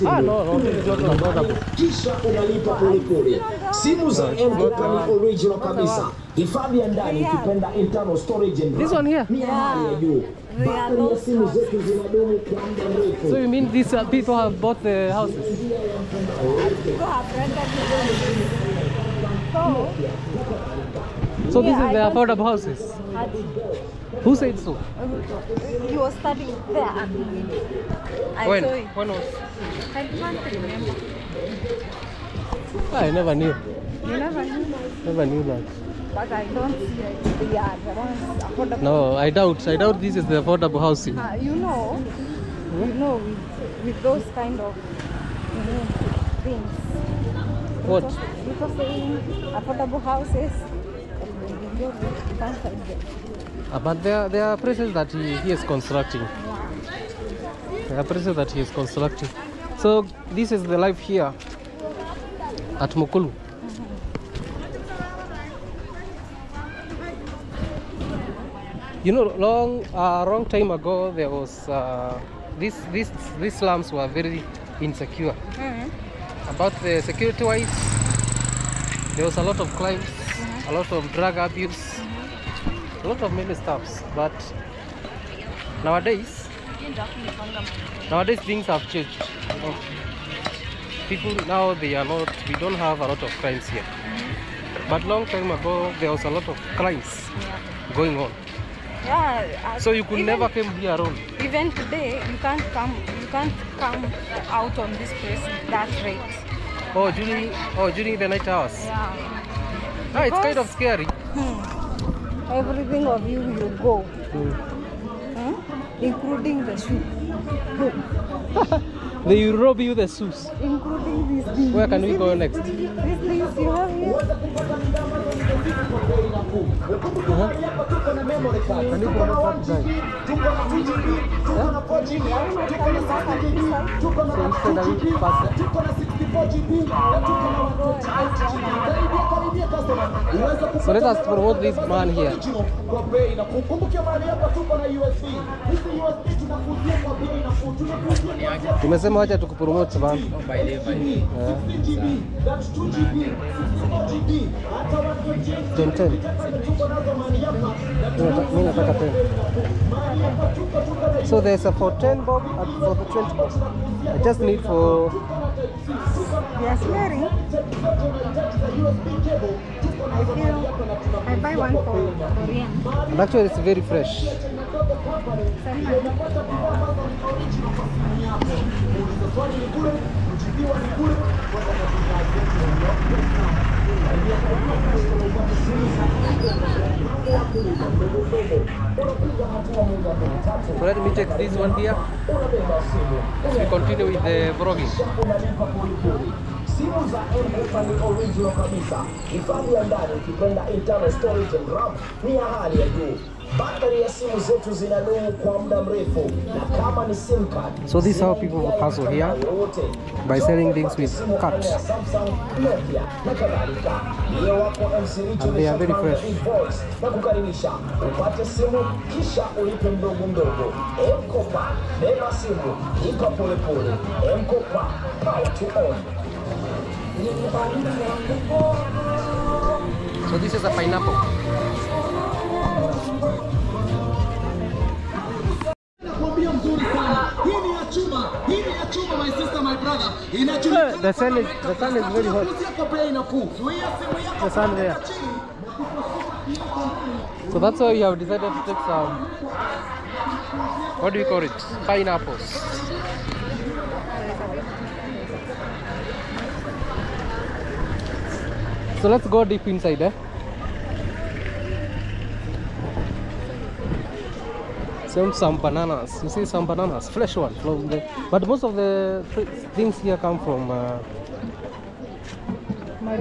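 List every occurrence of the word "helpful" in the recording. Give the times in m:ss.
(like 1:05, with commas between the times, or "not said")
not said.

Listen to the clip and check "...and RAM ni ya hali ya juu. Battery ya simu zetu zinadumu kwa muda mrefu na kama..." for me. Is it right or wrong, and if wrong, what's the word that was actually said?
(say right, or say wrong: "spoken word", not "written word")
right.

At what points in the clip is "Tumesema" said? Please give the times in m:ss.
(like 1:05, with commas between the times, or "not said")
2:28.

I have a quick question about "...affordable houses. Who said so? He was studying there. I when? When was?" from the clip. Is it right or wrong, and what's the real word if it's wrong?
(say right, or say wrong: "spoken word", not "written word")
right.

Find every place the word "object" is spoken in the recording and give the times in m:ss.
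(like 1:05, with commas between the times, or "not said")
not said.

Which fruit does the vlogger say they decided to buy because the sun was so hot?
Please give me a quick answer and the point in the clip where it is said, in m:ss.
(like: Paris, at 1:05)
Pineapples, at 4:11.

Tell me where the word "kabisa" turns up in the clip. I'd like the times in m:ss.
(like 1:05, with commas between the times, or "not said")
3:18.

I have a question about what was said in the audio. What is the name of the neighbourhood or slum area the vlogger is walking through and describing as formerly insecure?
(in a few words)
Mukulu.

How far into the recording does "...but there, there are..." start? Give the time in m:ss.
0:53.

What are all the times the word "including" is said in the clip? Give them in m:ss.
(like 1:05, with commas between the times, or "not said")
1:56, 2:00.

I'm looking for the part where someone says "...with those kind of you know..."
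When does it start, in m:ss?
0:43.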